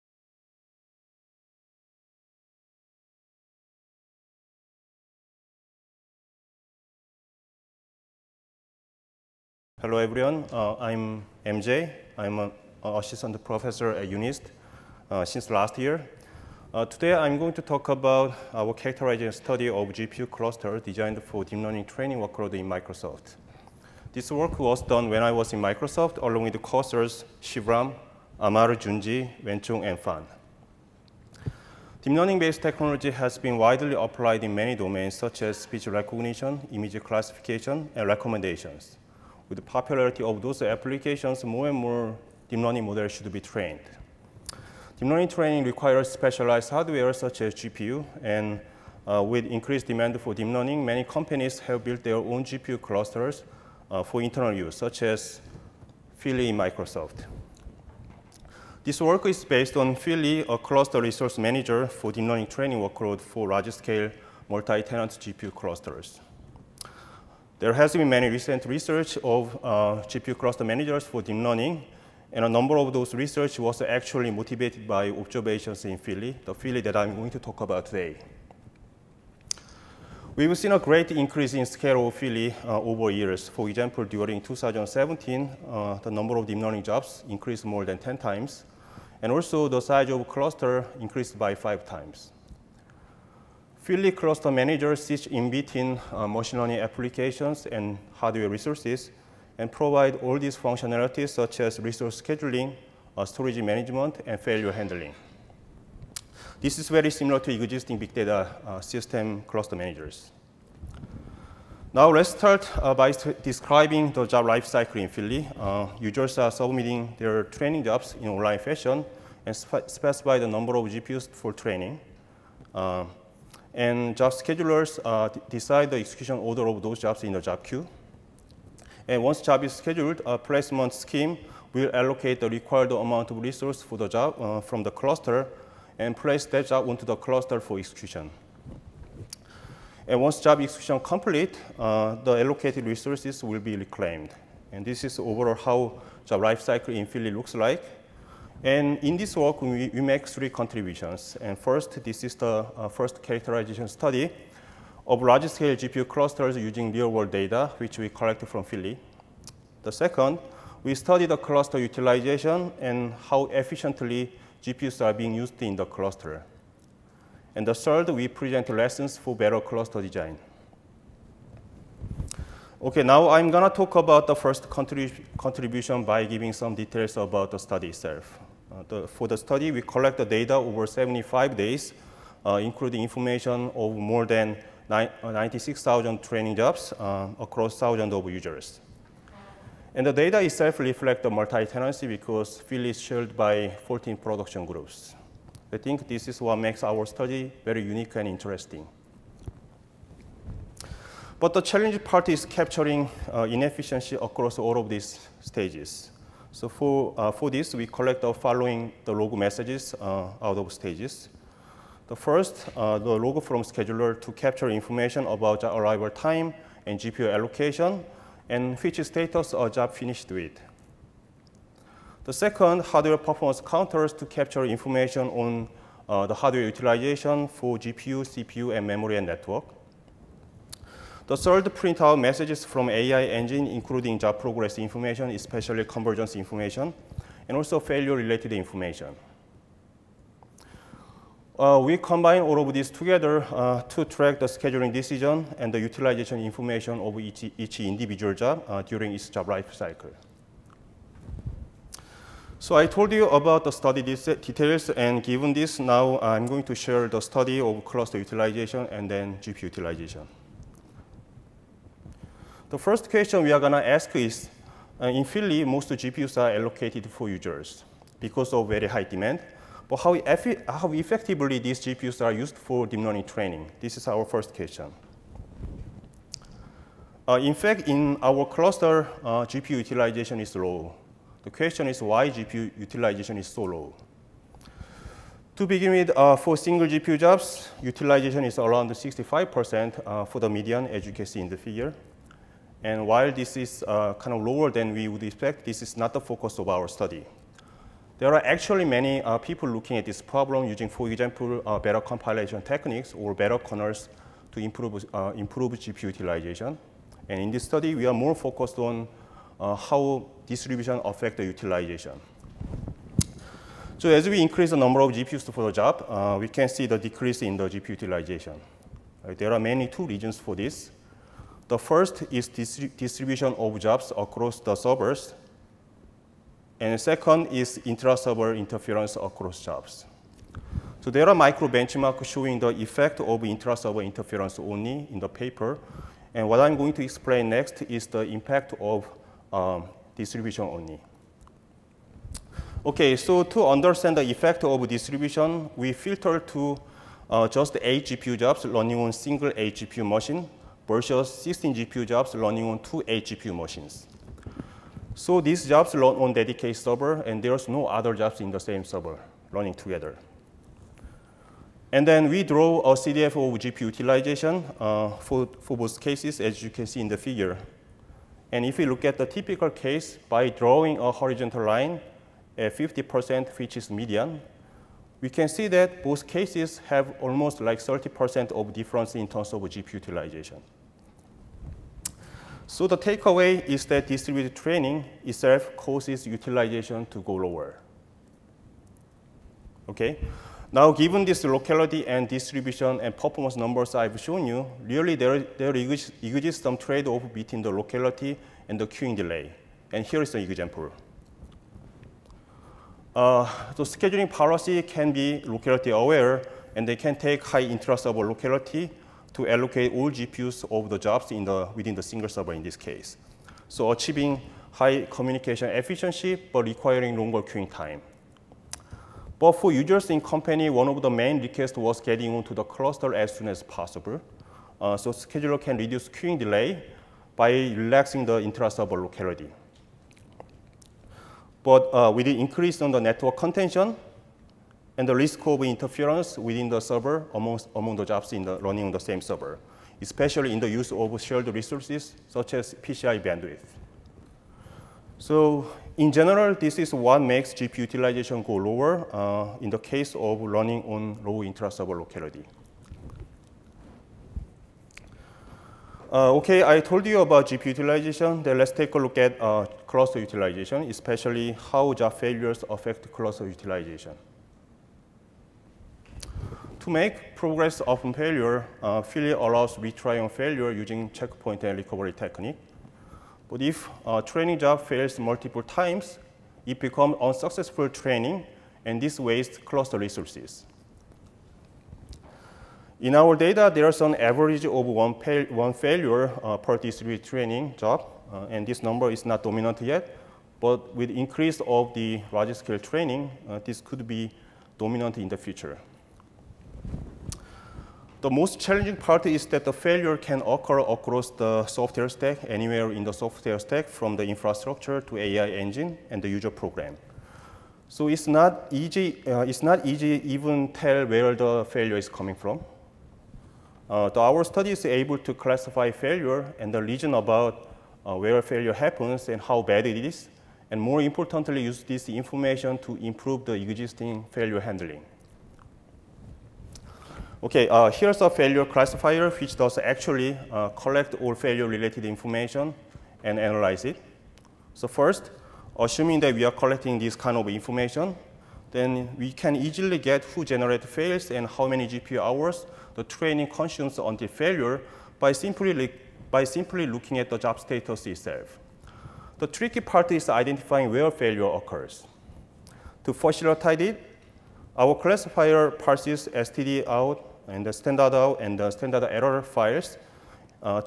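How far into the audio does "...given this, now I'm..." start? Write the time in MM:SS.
04:15.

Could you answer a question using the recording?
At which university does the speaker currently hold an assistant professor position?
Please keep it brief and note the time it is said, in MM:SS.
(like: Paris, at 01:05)
UNIST, at 00:14.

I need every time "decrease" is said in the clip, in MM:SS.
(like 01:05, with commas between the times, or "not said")
05:16.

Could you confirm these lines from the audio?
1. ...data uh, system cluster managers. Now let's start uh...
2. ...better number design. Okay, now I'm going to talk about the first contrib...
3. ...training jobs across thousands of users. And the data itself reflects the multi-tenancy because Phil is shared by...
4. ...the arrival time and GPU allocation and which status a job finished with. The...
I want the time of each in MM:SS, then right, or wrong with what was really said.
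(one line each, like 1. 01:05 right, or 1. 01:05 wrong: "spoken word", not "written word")
1. 01:48 right
2. 02:49 wrong: "cluster", not "number"
3. 03:06 right
4. 03:35 right.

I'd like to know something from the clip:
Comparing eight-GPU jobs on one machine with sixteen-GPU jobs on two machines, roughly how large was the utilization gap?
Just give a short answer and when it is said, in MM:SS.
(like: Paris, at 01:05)
30%, at 06:17.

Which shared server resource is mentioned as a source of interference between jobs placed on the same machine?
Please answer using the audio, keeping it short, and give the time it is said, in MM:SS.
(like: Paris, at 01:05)
PCI bandwidth, at 07:22.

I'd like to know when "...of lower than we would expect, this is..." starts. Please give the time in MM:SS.
04:54.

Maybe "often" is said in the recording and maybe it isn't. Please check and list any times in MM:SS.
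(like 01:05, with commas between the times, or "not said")
07:47.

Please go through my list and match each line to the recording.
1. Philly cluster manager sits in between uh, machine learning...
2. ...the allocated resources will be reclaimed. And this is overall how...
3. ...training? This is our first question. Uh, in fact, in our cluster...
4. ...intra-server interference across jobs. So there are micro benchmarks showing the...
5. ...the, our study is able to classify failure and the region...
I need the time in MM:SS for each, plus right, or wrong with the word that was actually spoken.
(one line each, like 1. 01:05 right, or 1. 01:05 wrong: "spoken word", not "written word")
1. 01:33 right
2. 02:22 right
3. 04:33 right
4. 05:27 right
5. 08:34 right.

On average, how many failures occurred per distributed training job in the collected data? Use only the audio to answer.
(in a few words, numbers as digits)
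1.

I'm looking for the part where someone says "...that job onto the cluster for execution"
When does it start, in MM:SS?
02:16.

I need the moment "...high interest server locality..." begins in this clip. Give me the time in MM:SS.
06:47.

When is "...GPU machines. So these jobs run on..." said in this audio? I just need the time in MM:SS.
05:53.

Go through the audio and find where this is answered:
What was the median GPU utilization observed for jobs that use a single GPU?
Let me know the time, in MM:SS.
04:48.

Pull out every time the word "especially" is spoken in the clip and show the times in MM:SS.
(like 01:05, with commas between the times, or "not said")
03:55, 07:20, 07:40.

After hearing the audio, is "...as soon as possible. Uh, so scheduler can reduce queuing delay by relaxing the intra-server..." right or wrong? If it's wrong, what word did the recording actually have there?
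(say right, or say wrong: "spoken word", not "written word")
right.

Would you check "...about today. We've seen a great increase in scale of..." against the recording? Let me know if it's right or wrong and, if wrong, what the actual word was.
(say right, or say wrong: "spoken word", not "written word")
right.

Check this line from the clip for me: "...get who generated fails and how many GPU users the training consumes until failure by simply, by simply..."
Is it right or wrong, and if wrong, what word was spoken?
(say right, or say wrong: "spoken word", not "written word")
wrong: "hours", not "users".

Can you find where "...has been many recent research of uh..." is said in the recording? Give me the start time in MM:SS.
01:07.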